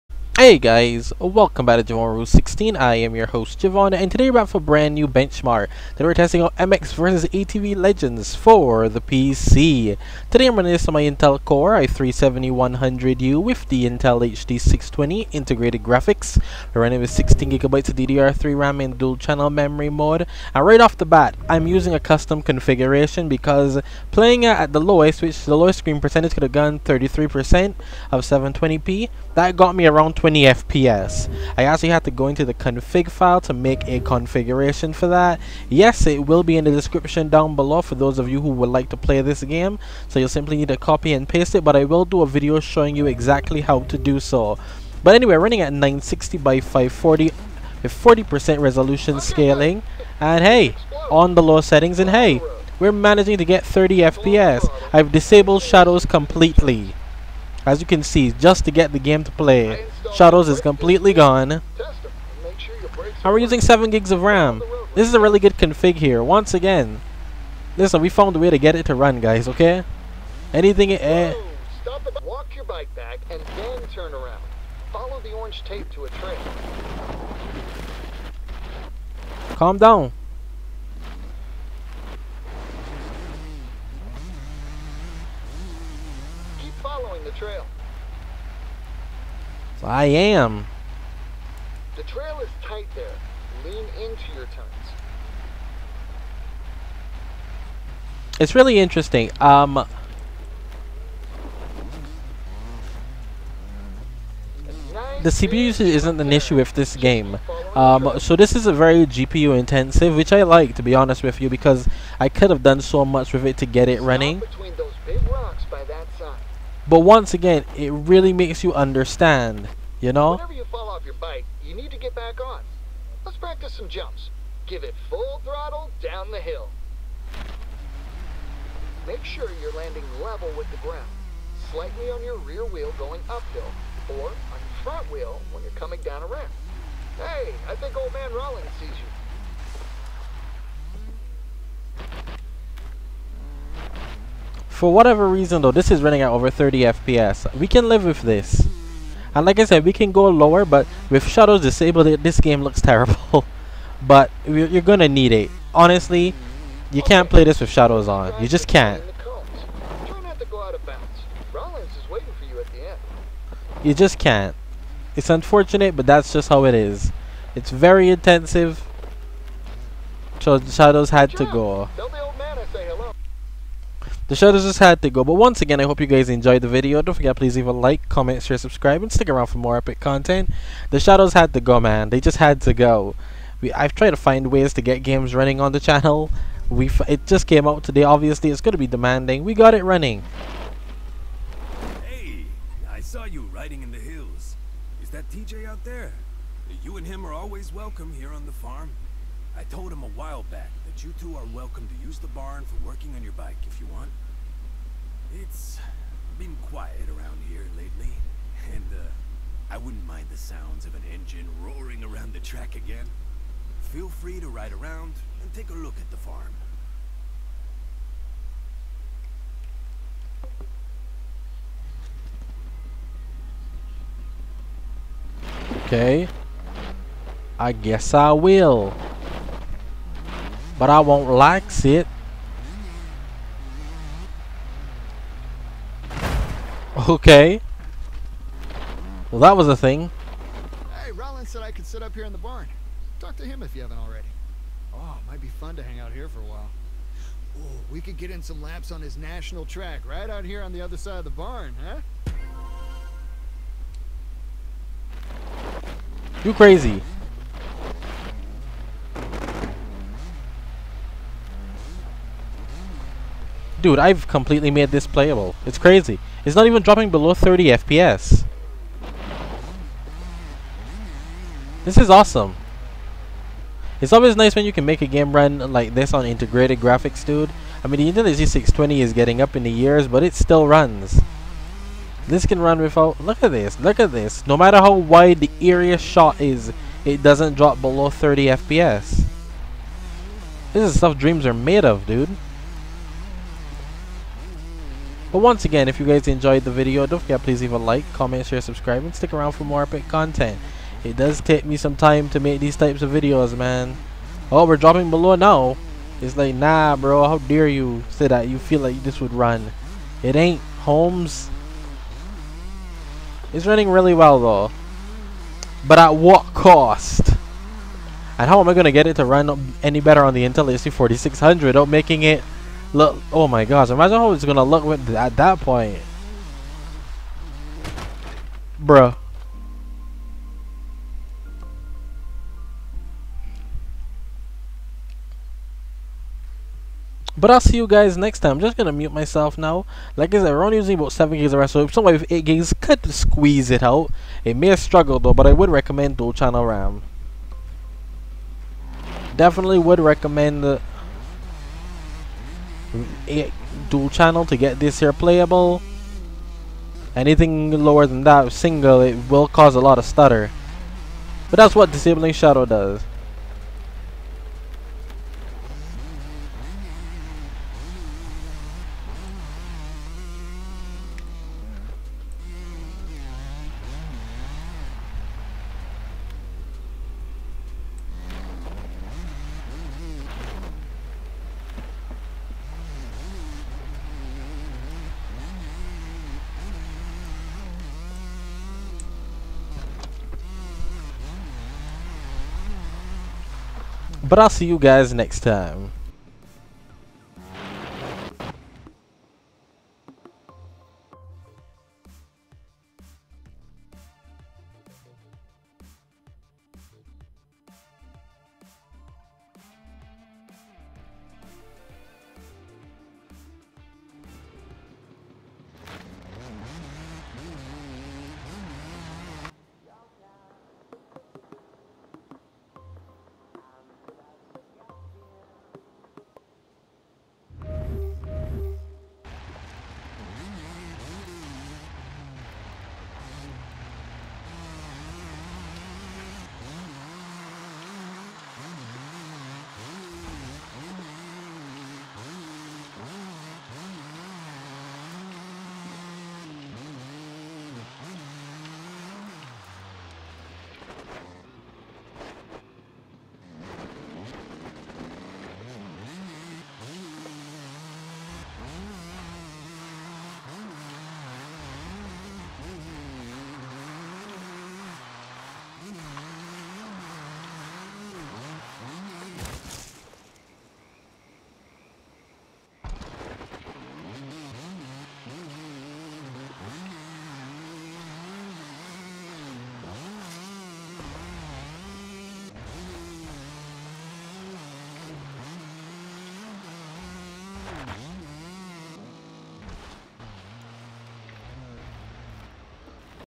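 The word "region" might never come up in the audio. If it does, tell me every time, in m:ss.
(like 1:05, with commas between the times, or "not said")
not said.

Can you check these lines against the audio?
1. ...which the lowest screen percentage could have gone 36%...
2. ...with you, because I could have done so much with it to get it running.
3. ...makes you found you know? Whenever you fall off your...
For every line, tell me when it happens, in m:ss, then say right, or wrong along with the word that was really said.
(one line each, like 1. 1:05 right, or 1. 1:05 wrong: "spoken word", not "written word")
1. 0:25 wrong: "33", not "36"
2. 1:51 right
3. 1:58 wrong: "understand", not "found".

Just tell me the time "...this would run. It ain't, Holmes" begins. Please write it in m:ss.
5:09.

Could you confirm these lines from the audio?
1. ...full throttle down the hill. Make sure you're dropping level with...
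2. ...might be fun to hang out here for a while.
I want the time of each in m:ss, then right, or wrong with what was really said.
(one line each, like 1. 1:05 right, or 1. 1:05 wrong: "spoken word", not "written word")
1. 2:05 wrong: "landing", not "dropping"
2. 4:05 right.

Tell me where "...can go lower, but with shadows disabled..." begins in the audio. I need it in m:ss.
2:29.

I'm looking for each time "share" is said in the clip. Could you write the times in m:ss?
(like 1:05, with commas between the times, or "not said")
2:58, 4:58.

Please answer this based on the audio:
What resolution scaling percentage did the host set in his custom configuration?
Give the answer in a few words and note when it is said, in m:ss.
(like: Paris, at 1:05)
40%, at 0:47.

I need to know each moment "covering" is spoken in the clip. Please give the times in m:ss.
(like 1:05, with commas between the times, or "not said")
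not said.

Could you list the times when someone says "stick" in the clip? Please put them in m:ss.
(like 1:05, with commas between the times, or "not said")
2:59, 4:59.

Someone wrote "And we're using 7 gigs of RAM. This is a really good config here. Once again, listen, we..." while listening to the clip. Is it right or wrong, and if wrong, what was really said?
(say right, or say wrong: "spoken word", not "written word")
right.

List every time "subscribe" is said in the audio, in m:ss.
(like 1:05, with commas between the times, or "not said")
2:58, 4:58.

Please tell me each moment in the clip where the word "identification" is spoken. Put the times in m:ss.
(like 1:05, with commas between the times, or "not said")
not said.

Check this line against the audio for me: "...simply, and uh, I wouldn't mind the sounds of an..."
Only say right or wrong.
wrong.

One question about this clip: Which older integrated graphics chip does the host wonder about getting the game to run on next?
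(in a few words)
Intel HD 4600.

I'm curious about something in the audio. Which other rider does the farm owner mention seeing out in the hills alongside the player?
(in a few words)
TJ.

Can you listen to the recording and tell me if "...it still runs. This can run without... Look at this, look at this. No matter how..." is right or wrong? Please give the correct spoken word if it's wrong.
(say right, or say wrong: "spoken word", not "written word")
right.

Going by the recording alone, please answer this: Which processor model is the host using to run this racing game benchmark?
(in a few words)
Intel Core i3-7100U.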